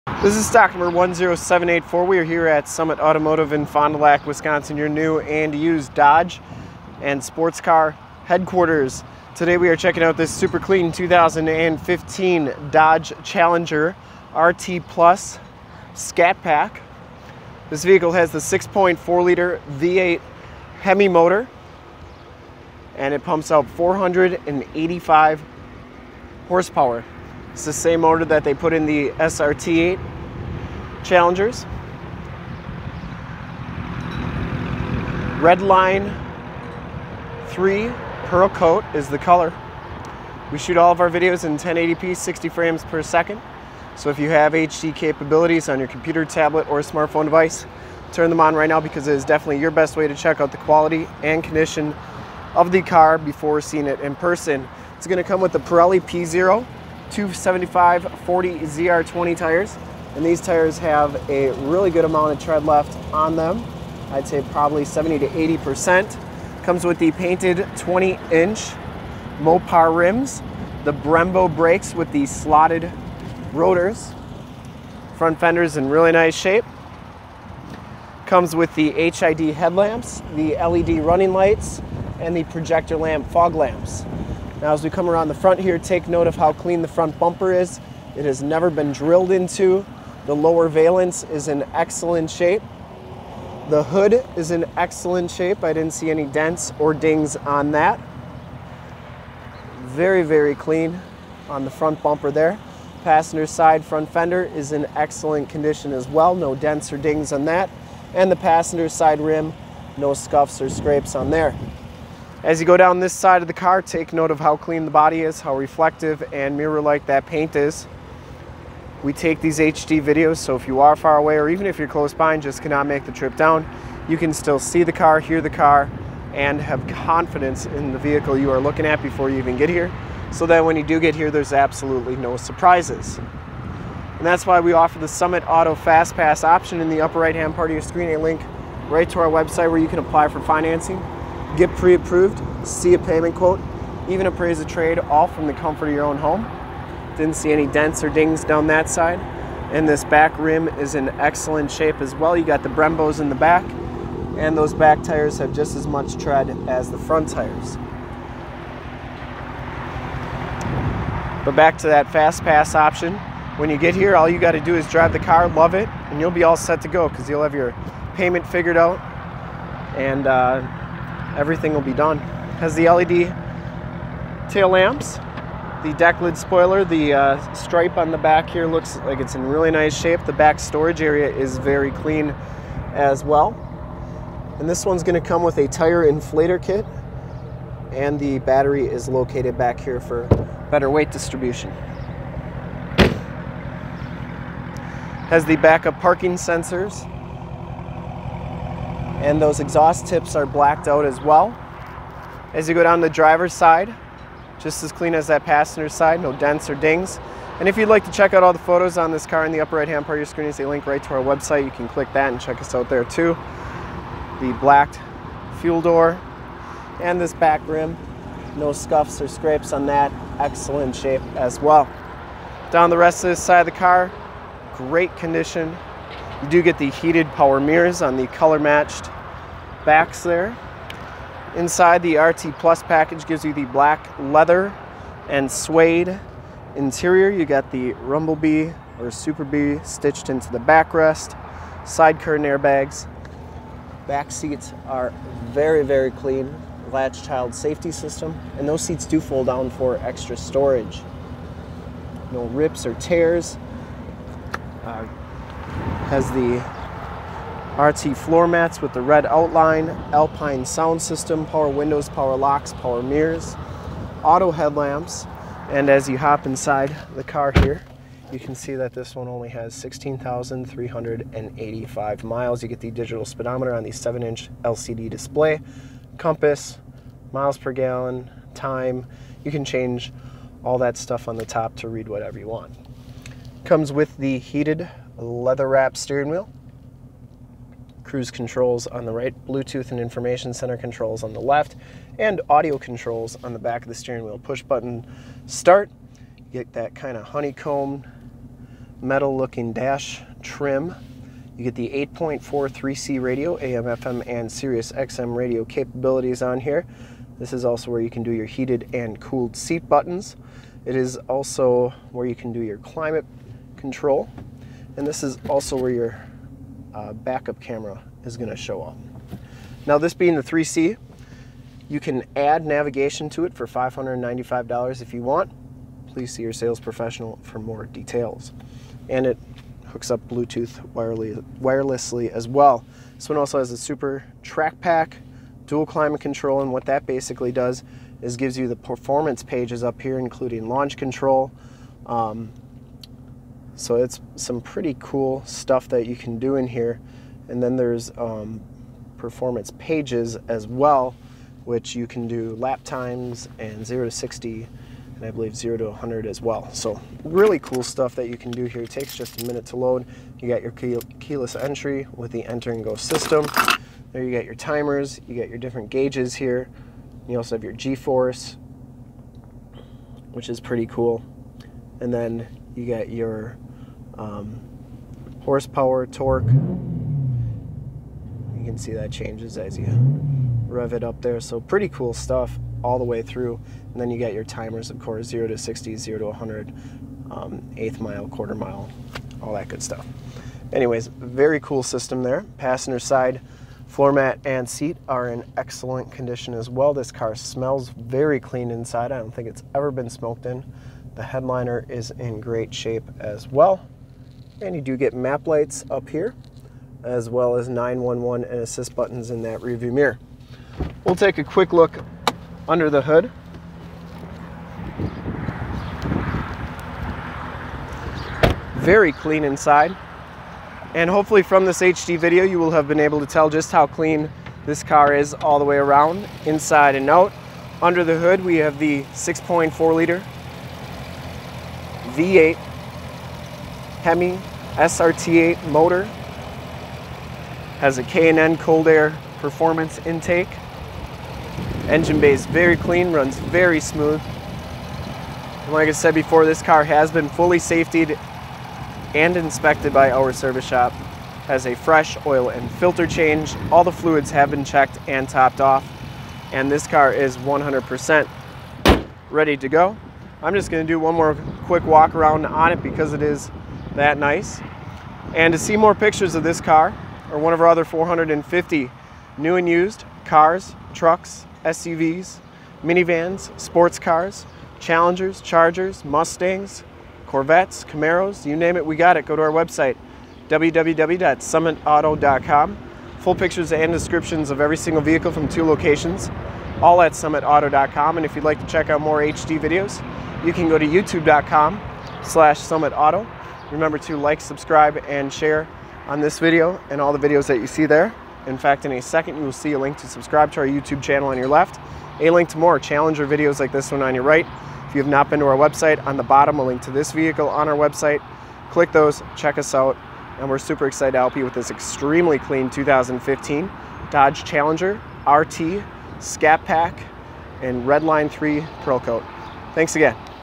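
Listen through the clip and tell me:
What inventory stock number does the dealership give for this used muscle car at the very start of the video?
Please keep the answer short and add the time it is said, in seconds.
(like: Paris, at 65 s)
10784, at 0 s.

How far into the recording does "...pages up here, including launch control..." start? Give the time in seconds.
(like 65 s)
339 s.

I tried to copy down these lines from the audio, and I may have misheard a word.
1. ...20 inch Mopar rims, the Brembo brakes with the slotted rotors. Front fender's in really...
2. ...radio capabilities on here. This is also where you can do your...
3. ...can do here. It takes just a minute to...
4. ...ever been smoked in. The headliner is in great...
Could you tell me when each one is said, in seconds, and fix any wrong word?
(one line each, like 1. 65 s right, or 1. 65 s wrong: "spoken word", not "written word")
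1. 67 s right
2. 305 s right
3. 358 s right
4. 399 s right.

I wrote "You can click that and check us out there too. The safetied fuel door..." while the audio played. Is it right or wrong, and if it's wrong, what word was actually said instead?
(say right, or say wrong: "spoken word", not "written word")
wrong: "blacked", not "safetied".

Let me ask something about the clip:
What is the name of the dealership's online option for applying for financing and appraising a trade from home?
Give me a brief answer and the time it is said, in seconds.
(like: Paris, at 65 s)
Summit Auto Fast Pass, at 135 s.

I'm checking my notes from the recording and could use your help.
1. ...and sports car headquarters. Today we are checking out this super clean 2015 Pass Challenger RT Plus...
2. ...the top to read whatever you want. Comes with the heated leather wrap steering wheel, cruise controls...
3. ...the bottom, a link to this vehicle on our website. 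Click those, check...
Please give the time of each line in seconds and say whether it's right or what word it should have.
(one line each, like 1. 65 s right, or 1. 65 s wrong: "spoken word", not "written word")
1. 7 s wrong: "Dodge", not "Pass"
2. 281 s right
3. 506 s right.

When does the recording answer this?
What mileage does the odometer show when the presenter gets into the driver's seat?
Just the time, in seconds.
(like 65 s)
269 s.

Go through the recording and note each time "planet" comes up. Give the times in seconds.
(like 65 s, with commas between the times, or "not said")
not said.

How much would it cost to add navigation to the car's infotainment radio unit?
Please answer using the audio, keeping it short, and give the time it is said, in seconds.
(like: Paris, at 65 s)
$595, at 323 s.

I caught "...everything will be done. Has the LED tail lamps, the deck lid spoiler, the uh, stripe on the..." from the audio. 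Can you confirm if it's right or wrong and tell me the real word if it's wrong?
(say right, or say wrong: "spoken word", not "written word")
right.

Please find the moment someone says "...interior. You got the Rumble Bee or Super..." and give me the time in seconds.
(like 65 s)
236 s.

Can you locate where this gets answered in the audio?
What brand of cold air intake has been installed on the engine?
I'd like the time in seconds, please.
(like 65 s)
438 s.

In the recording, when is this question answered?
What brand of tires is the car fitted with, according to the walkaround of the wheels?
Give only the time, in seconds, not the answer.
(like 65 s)
55 s.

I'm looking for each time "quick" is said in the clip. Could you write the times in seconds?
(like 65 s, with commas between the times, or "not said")
411 s, 461 s.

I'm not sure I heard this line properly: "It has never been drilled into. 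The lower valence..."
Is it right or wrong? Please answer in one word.
right.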